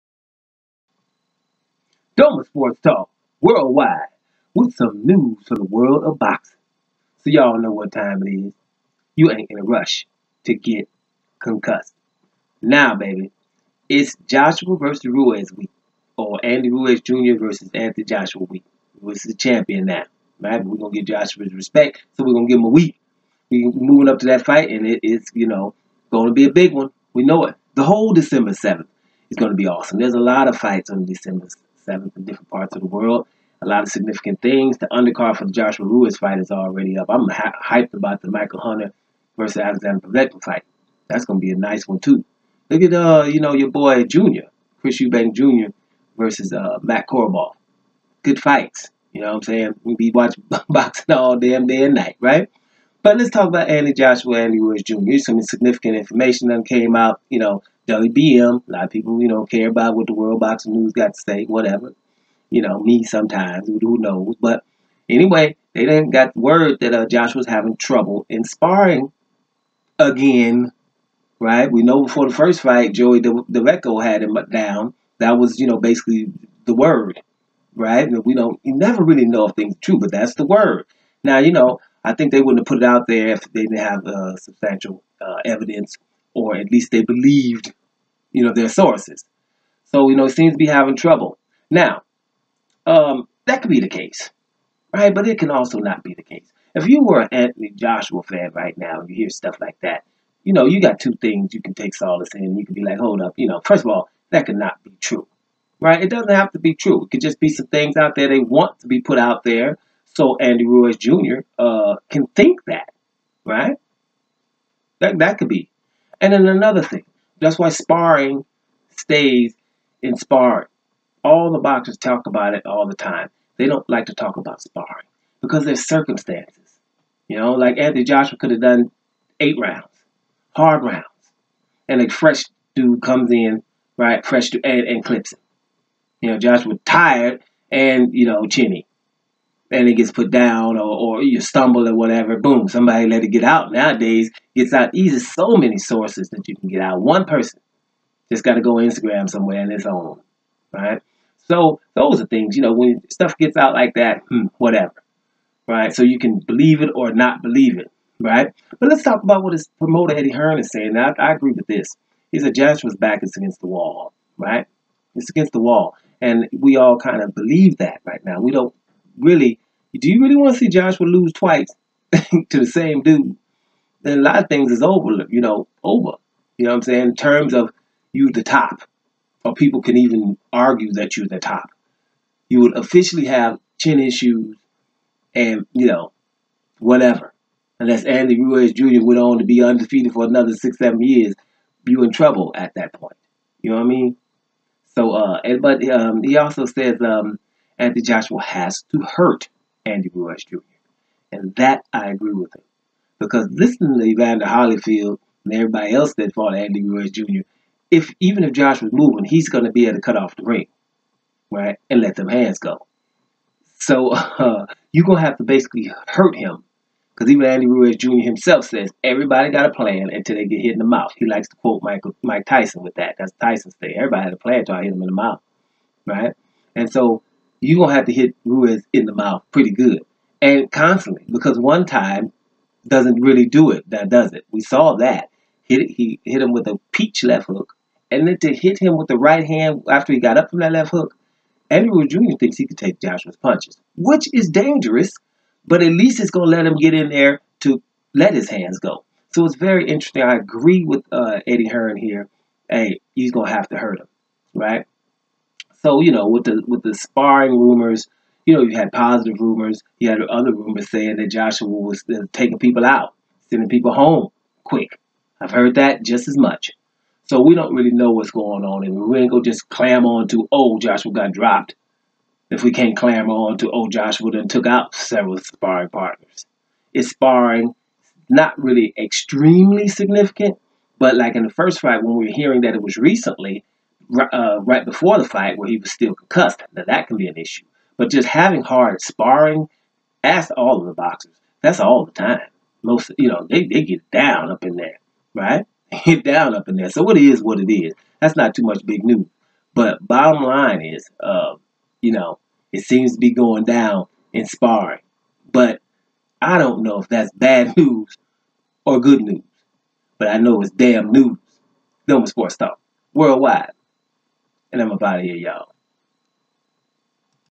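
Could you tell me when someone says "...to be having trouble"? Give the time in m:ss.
1:30.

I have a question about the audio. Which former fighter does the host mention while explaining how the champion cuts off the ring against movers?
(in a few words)
Evander Holyfield.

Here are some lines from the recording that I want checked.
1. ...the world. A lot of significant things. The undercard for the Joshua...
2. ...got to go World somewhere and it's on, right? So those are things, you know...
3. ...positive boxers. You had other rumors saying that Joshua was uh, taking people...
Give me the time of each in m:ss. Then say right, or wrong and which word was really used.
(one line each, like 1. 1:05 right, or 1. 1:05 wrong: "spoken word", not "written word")
1. 0:32 right
2. 2:28 wrong: "Instagram", not "World"
3. 4:18 wrong: "rumors", not "boxers".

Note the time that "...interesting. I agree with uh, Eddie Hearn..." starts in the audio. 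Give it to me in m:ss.
4:09.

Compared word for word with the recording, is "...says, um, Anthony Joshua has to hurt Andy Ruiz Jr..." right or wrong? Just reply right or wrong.
right.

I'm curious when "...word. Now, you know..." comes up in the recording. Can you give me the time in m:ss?
1:20.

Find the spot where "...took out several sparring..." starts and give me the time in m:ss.
4:34.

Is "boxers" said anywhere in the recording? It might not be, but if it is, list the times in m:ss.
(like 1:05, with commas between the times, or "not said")
2:01, 4:50.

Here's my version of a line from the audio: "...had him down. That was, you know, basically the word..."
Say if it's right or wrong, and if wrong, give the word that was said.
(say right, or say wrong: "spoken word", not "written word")
right.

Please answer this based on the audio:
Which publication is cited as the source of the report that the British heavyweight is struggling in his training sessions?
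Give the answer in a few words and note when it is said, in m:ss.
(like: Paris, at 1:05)
World Boxing News, at 1:00.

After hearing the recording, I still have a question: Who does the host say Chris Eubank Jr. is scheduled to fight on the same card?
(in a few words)
Matt Korobov.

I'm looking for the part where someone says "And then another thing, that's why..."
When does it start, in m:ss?
1:56.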